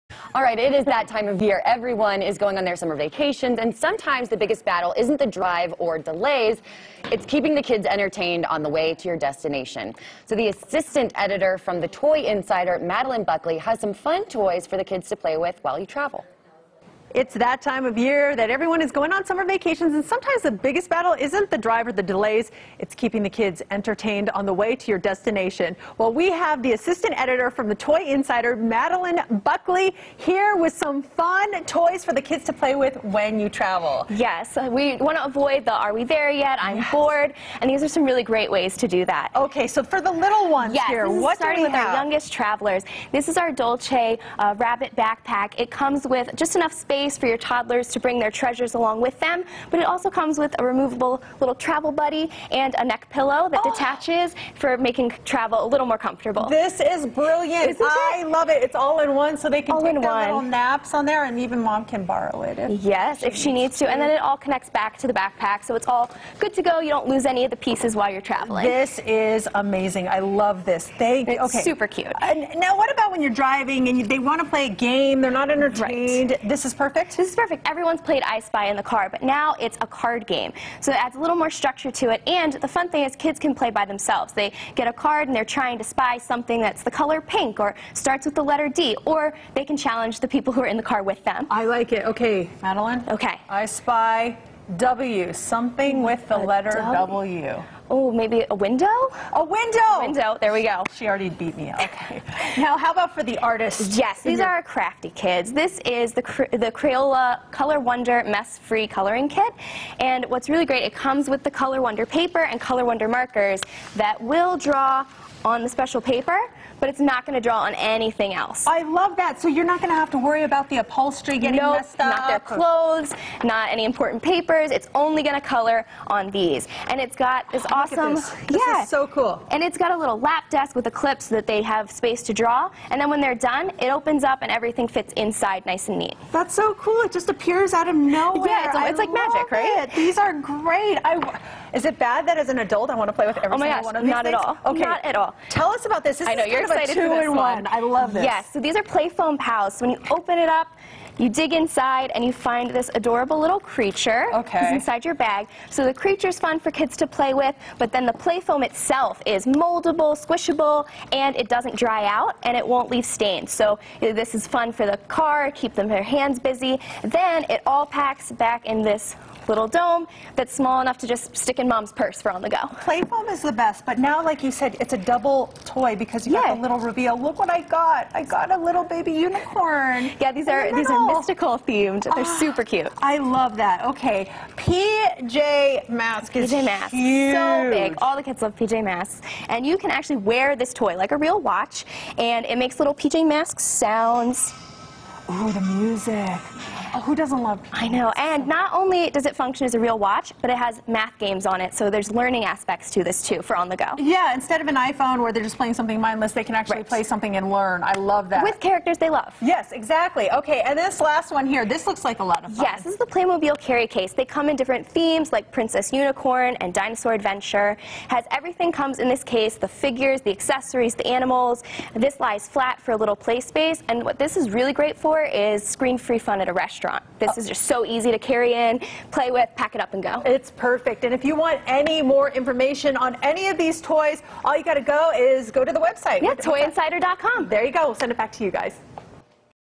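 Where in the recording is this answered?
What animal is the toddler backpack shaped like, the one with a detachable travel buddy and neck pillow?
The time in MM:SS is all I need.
00:44.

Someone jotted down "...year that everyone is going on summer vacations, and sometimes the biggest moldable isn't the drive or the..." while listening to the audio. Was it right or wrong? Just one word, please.
wrong.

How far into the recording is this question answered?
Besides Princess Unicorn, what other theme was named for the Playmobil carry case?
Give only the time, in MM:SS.
03:36.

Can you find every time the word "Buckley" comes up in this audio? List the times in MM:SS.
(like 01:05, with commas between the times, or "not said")
00:13, 00:29.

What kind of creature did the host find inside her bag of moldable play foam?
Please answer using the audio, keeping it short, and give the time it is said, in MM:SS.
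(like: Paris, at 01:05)
Baby unicorn, at 02:58.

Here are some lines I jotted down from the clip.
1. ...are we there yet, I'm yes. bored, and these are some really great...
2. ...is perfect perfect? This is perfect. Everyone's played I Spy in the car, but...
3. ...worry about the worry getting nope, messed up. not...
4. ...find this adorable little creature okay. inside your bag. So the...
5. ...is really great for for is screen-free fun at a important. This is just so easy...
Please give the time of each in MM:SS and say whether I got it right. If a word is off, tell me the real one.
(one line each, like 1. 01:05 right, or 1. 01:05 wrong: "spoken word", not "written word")
1. 00:35 right
2. 01:16 right
3. 02:00 wrong: "upholstery", not "worry"
4. 02:32 right
5. 03:44 wrong: "restaurant", not "important".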